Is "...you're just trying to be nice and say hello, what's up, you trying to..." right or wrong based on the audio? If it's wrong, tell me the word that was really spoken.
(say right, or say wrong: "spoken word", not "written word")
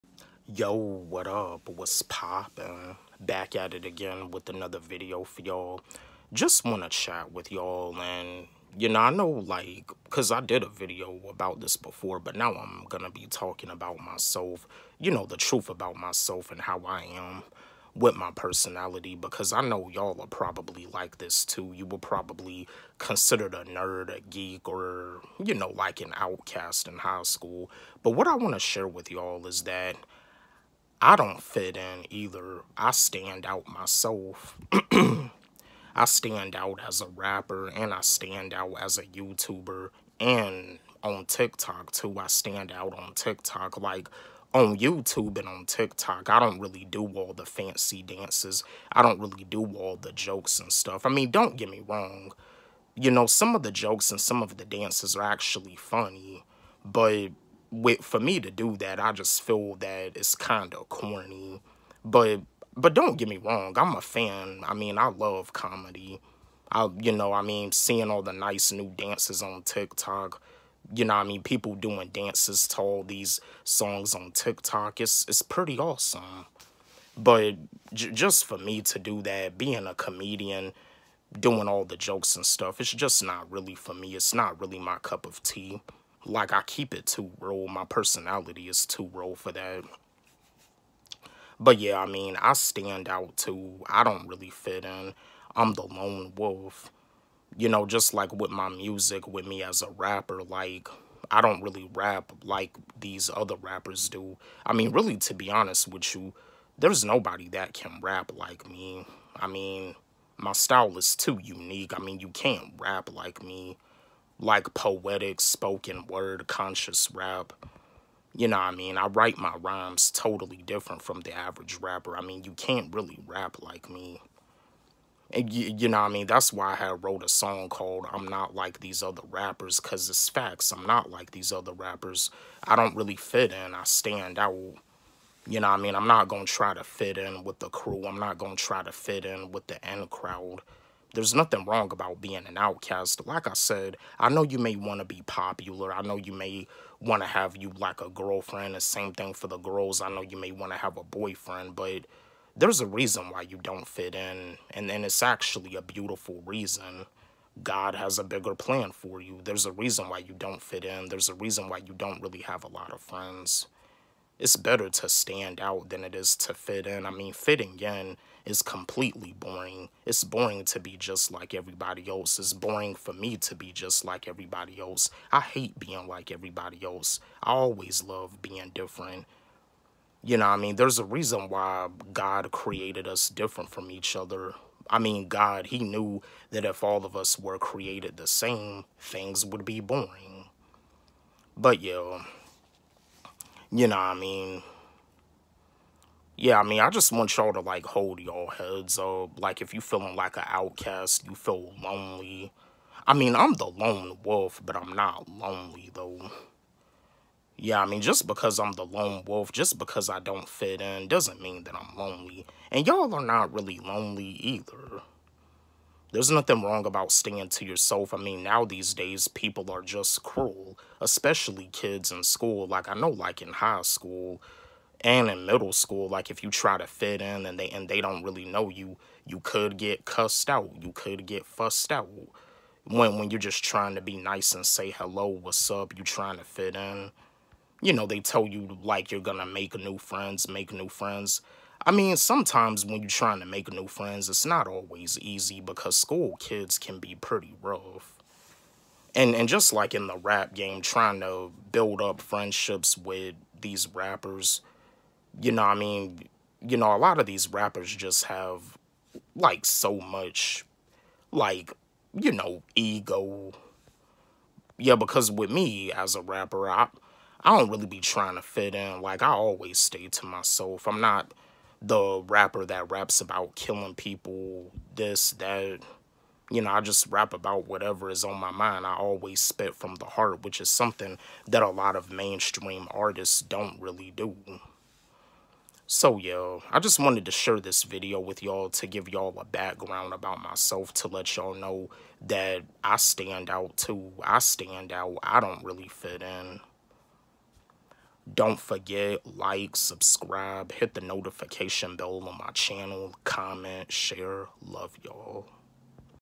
right.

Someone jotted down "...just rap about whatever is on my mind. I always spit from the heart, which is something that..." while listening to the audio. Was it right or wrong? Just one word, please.
right.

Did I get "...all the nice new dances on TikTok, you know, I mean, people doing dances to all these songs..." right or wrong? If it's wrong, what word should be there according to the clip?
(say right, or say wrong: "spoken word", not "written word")
right.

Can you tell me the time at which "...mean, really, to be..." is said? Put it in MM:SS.
01:44.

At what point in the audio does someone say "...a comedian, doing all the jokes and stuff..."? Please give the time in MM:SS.
01:19.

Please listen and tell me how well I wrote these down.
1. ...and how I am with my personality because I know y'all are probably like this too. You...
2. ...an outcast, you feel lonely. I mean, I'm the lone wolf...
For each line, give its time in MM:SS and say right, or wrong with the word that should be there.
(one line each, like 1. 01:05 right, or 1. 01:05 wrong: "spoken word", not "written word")
1. 00:16 right
2. 03:20 right.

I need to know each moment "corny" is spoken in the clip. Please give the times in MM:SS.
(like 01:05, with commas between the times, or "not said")
01:00.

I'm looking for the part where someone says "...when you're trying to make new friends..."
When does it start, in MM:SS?
04:02.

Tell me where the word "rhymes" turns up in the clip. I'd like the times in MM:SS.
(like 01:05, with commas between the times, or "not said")
01:59.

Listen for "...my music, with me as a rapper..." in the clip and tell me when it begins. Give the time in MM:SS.
01:38.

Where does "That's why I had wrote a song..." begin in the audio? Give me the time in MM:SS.
02:06.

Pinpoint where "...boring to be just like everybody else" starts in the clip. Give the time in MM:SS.
02:50.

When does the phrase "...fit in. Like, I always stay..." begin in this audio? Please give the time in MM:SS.
04:28.